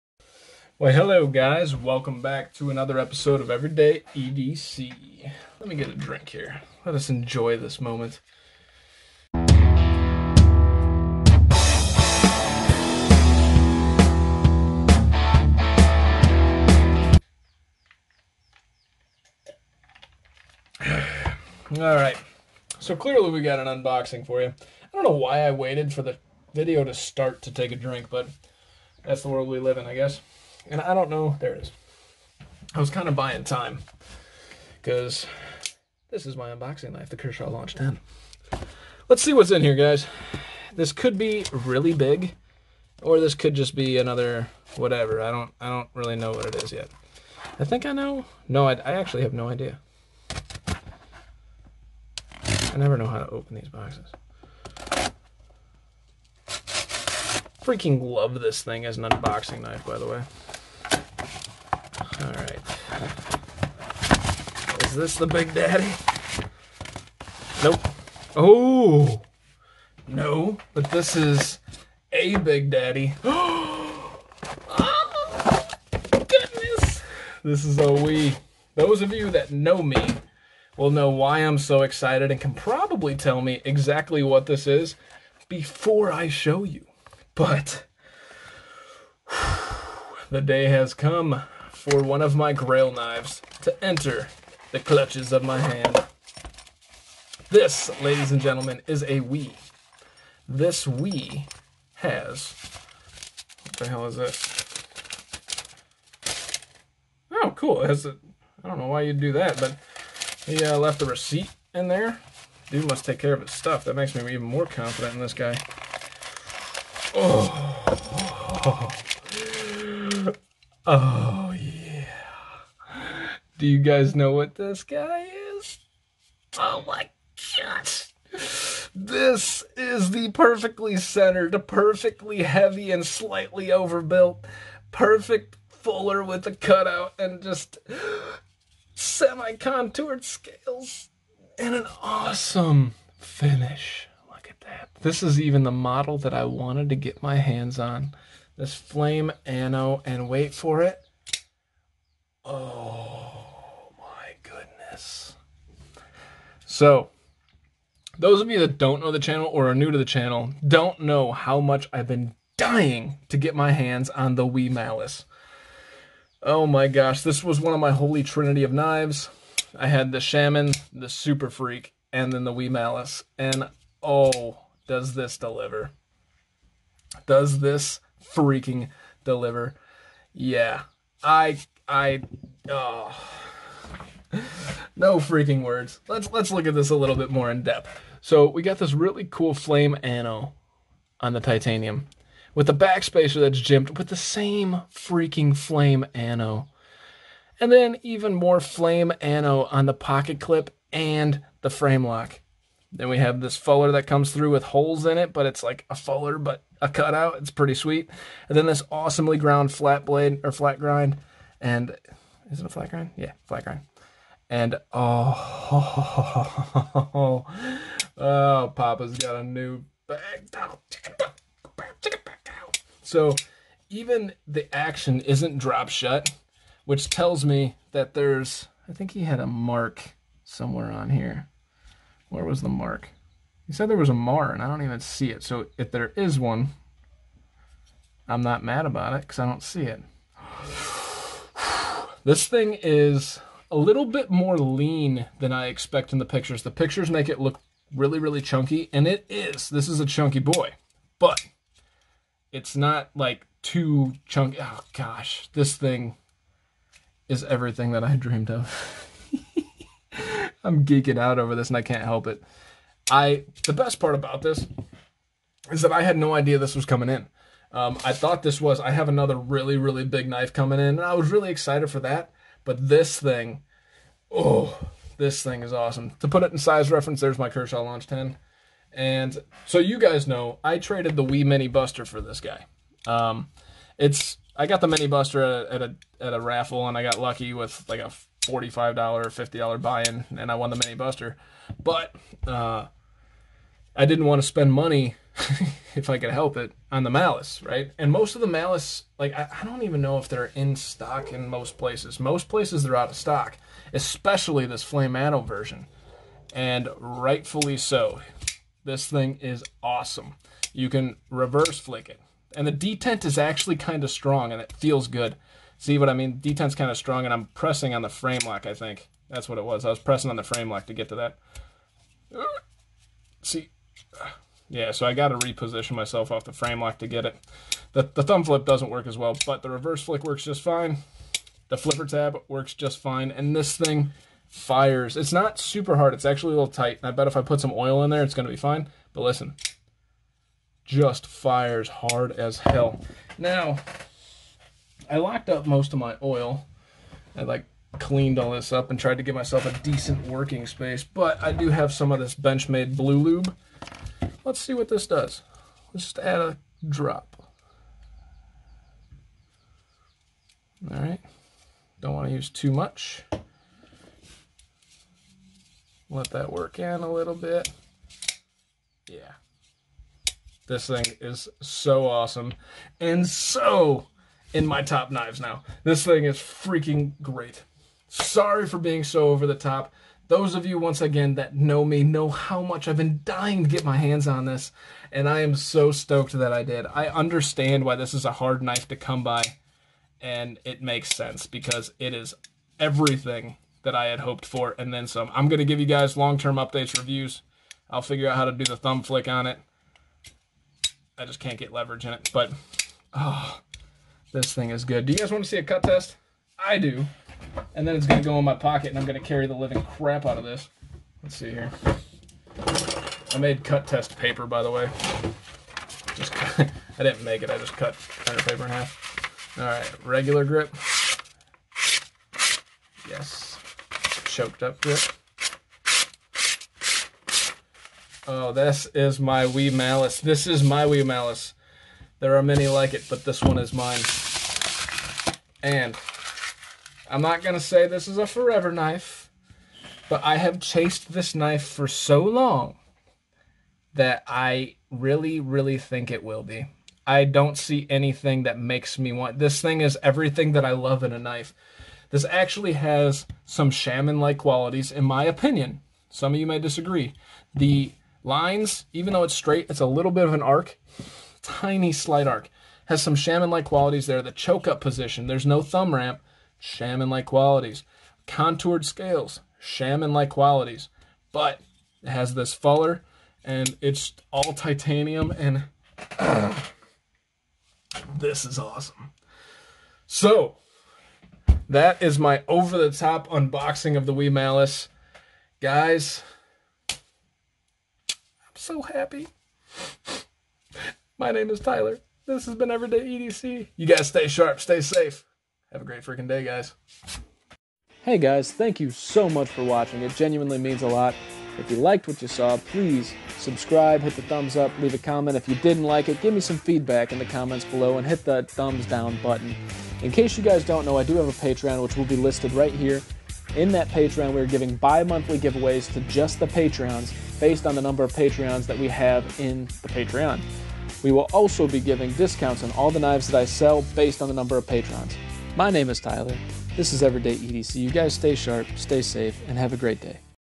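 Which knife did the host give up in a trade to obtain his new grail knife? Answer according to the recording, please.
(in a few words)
WE Mini Buster.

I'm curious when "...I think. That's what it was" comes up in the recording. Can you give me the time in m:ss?
5:18.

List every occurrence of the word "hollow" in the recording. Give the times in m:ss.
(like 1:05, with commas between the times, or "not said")
not said.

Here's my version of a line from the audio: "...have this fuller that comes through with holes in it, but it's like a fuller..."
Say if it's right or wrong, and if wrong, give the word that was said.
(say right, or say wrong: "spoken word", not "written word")
right.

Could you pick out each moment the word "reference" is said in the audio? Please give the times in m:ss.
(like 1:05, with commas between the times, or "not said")
4:36.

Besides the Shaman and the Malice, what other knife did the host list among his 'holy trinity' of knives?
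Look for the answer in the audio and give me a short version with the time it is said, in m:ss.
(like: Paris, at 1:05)
Super Freek, at 2:51.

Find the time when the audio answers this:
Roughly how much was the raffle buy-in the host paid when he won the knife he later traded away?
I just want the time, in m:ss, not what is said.
4:48.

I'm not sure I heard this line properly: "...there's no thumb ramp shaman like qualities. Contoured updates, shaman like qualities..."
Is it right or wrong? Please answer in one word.
wrong.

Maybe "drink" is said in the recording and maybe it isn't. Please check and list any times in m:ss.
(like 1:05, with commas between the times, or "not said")
0:05, 0:27.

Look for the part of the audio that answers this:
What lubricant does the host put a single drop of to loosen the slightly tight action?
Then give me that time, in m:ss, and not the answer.
5:52.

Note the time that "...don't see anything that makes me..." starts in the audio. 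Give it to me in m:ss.
7:27.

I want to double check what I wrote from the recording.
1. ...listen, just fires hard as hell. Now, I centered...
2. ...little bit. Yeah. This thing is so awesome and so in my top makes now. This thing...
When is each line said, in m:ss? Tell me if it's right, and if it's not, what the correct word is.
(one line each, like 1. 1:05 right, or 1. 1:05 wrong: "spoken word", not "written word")
1. 5:39 wrong: "locked", not "centered"
2. 6:07 wrong: "knives", not "makes".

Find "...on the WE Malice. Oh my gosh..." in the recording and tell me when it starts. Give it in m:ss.
2:44.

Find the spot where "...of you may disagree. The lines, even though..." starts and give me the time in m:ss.
7:36.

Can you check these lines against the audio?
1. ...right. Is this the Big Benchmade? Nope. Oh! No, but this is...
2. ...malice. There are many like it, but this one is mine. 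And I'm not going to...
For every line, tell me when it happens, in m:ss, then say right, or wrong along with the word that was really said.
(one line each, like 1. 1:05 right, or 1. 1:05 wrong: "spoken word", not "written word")
1. 1:02 wrong: "Daddy", not "Benchmade"
2. 7:11 right.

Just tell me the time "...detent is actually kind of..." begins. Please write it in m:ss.
5:12.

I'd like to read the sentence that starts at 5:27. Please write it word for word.
The, the thumb flip doesn't work as well, but the reverse flick works just fine.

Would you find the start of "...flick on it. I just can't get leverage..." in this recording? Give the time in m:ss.
6:39.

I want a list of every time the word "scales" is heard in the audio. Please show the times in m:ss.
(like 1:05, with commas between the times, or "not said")
2:20, 7:48.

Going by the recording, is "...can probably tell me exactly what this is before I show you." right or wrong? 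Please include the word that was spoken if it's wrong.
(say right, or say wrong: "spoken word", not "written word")
right.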